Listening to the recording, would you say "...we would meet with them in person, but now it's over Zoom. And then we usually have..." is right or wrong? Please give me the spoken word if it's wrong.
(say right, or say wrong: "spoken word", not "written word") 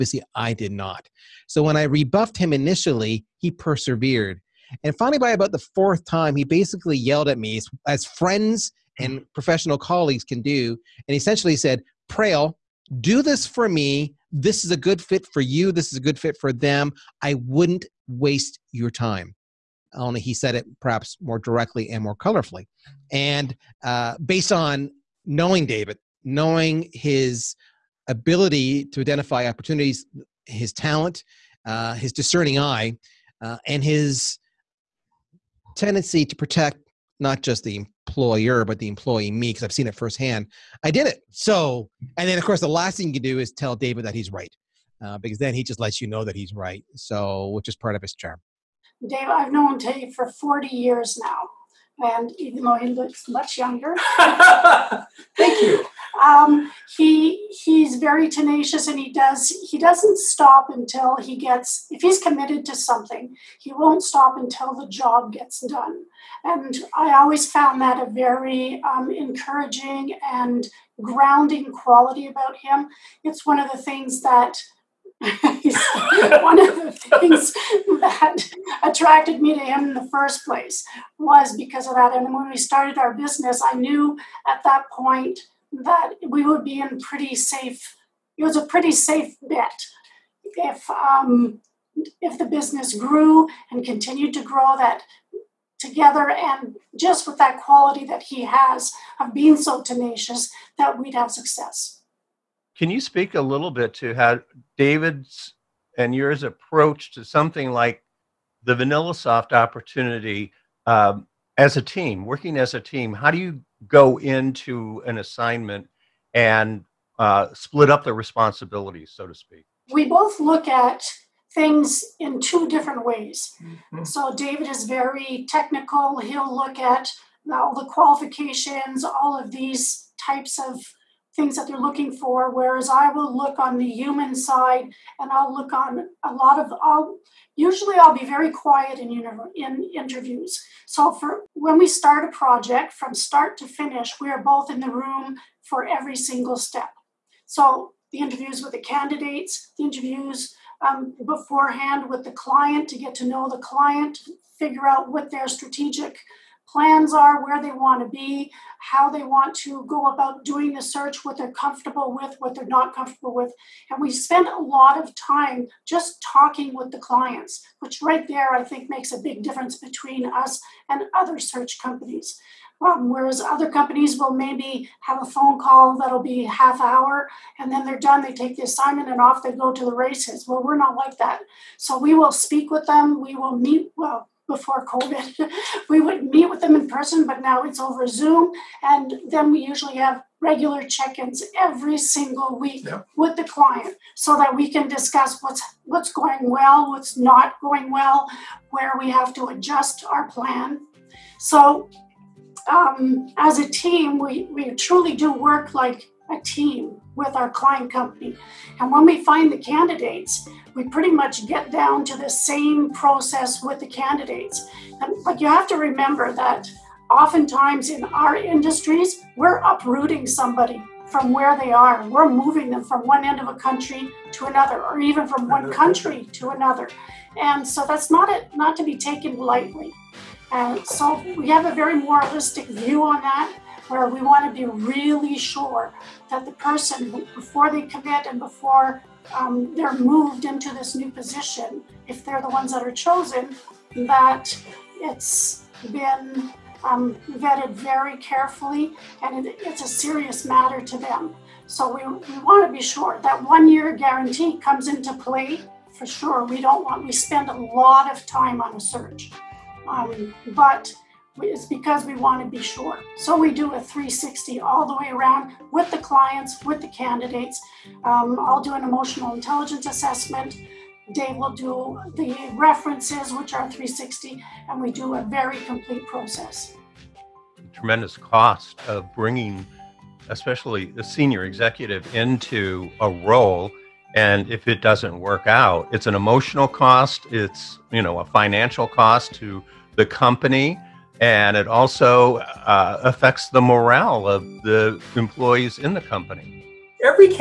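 right.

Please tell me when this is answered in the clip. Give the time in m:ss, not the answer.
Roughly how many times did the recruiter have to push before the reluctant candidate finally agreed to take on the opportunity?
0:05.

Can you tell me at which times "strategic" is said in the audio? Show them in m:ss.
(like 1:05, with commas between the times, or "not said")
2:35.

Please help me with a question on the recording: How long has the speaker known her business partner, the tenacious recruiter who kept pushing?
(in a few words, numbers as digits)
40 years.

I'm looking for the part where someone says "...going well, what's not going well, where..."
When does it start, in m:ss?
3:16.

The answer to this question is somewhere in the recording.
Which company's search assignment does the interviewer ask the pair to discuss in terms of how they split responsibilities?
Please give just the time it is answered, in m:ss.
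1:48.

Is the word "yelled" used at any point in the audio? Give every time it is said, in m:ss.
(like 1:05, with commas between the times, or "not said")
0:06.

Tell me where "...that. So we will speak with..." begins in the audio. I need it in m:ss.
3:01.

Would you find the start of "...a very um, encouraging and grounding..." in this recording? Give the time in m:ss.
1:08.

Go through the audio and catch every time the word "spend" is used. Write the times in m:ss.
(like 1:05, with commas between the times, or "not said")
2:44, 4:17.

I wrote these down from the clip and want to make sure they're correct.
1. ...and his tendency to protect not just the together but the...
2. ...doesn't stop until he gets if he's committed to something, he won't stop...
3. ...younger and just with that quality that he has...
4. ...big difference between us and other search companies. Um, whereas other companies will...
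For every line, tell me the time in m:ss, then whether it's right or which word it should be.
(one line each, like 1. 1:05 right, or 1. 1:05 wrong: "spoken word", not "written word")
1. 0:33 wrong: "employer", not "together"
2. 0:59 right
3. 1:35 wrong: "together", not "younger"
4. 2:49 right.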